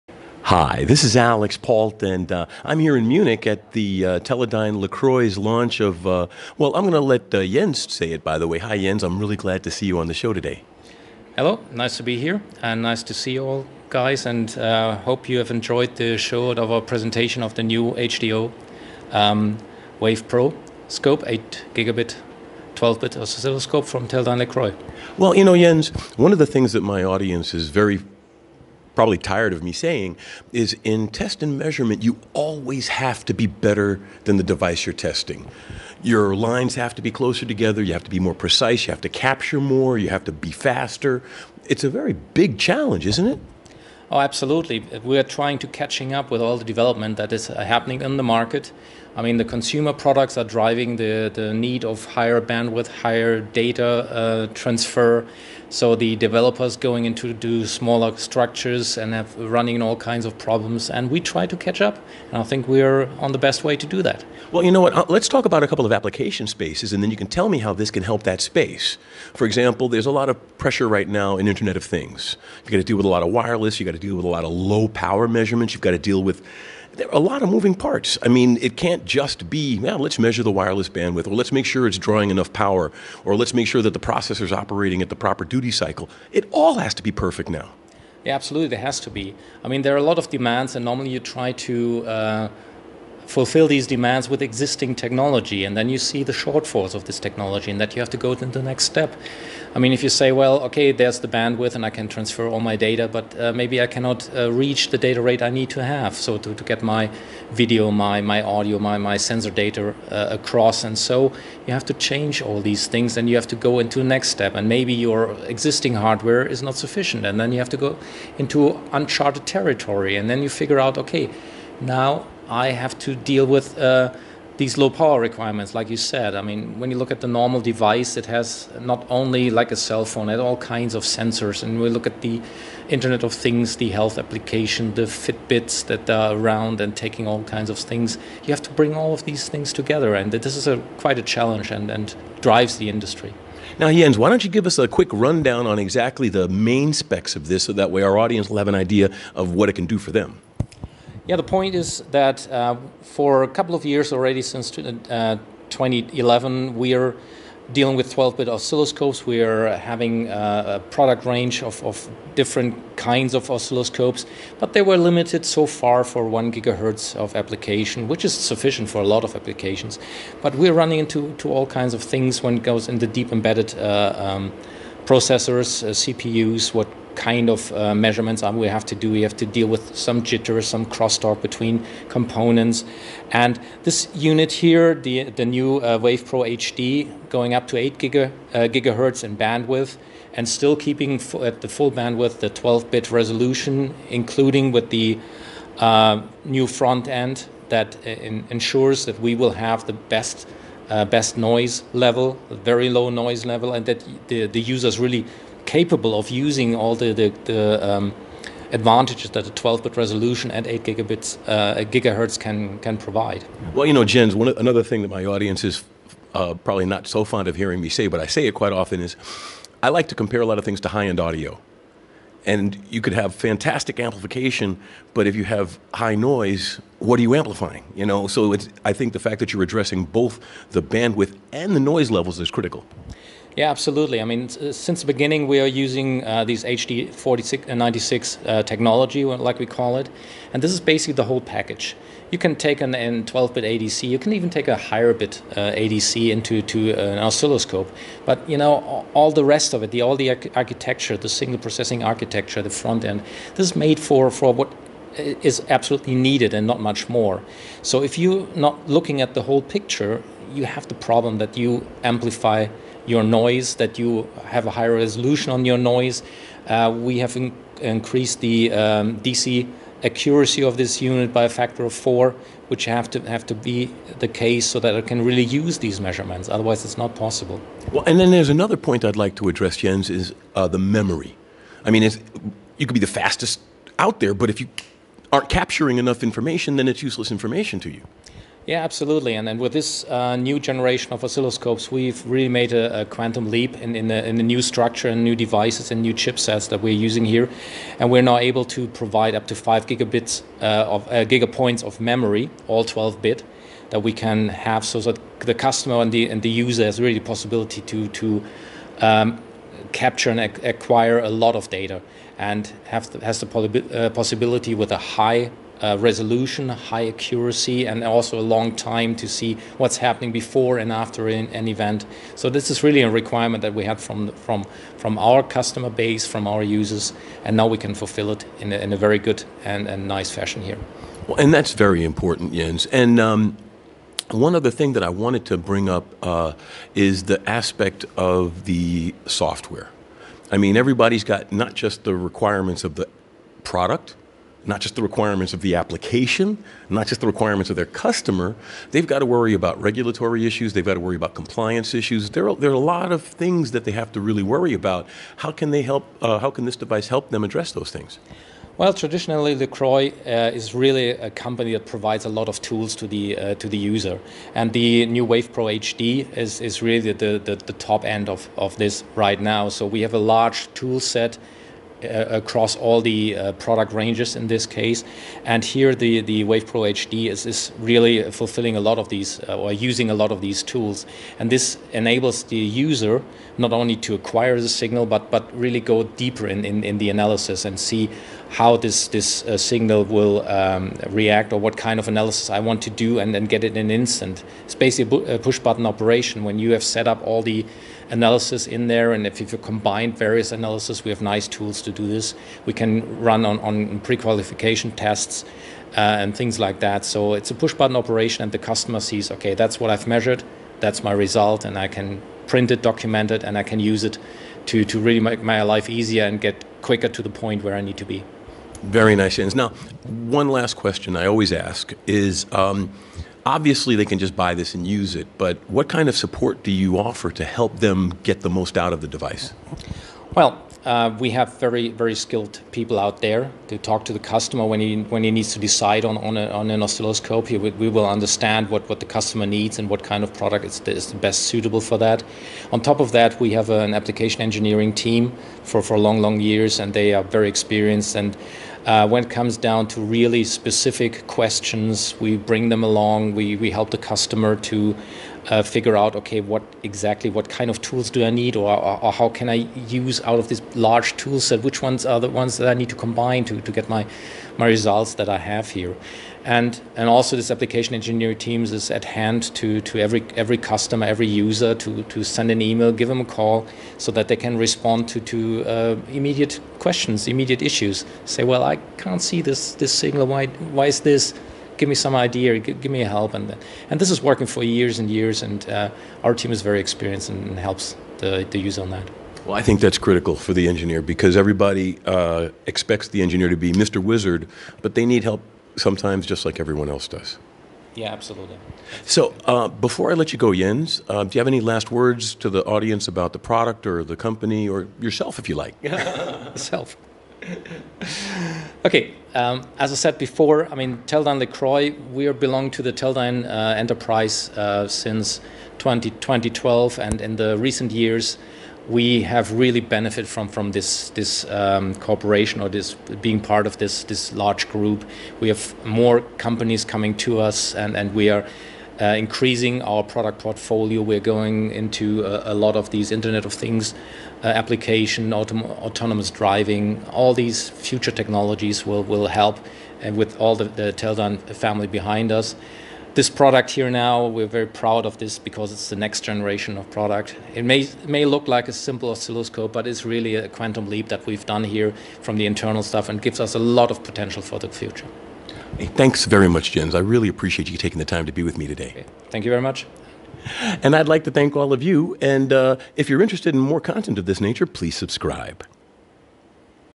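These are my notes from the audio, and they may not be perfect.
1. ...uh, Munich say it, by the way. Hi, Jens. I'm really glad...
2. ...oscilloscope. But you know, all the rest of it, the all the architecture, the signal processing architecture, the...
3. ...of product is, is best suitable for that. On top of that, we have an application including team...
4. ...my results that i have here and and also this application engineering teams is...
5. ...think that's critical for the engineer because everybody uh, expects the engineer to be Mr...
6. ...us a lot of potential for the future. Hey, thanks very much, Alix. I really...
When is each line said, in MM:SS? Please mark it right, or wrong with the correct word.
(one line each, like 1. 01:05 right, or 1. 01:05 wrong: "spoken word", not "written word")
1. 00:07 wrong: "Jens", not "Munich"
2. 04:07 right
3. 07:20 wrong: "engineering", not "including"
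4. 07:44 right
5. 08:09 right
6. 09:13 wrong: "Jens", not "Alix".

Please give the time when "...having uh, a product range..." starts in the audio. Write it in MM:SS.
02:39.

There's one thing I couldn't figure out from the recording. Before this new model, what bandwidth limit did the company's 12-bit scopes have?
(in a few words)
1 gigahertz.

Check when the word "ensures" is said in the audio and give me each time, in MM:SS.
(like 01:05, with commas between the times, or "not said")
03:18.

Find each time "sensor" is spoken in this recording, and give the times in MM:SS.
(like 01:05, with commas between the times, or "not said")
01:49, 02:11.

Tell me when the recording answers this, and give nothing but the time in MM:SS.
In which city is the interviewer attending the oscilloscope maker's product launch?
00:03.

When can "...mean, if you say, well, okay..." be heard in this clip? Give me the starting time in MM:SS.
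01:39.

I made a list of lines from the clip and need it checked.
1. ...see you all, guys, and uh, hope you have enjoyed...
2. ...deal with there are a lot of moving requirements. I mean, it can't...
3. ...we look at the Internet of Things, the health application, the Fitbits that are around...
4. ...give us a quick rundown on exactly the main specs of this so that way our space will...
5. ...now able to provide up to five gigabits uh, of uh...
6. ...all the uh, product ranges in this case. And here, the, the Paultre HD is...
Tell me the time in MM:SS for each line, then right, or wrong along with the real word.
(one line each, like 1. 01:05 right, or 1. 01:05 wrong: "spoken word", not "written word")
1. 00:13 right
2. 01:15 wrong: "parts", not "requirements"
3. 02:11 right
4. 02:24 wrong: "audience", not "space"
5. 04:58 right
6. 06:12 wrong: "WavePro", not "Paultre".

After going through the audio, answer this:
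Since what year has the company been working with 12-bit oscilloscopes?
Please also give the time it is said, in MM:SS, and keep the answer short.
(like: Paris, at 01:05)
2011, at 02:35.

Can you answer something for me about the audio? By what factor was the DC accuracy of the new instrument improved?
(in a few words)
4.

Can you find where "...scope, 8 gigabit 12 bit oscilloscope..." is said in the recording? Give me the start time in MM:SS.
00:20.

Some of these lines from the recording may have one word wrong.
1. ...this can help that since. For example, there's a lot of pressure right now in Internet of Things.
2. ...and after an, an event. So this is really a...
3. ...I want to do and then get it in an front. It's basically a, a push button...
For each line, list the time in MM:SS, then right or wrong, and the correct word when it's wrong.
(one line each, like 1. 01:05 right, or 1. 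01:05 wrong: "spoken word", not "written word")
1. 01:07 wrong: "space", not "since"
2. 05:20 right
3. 06:32 wrong: "instant", not "front".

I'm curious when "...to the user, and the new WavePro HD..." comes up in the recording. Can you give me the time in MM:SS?
06:03.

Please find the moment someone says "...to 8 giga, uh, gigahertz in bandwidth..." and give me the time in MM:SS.
03:07.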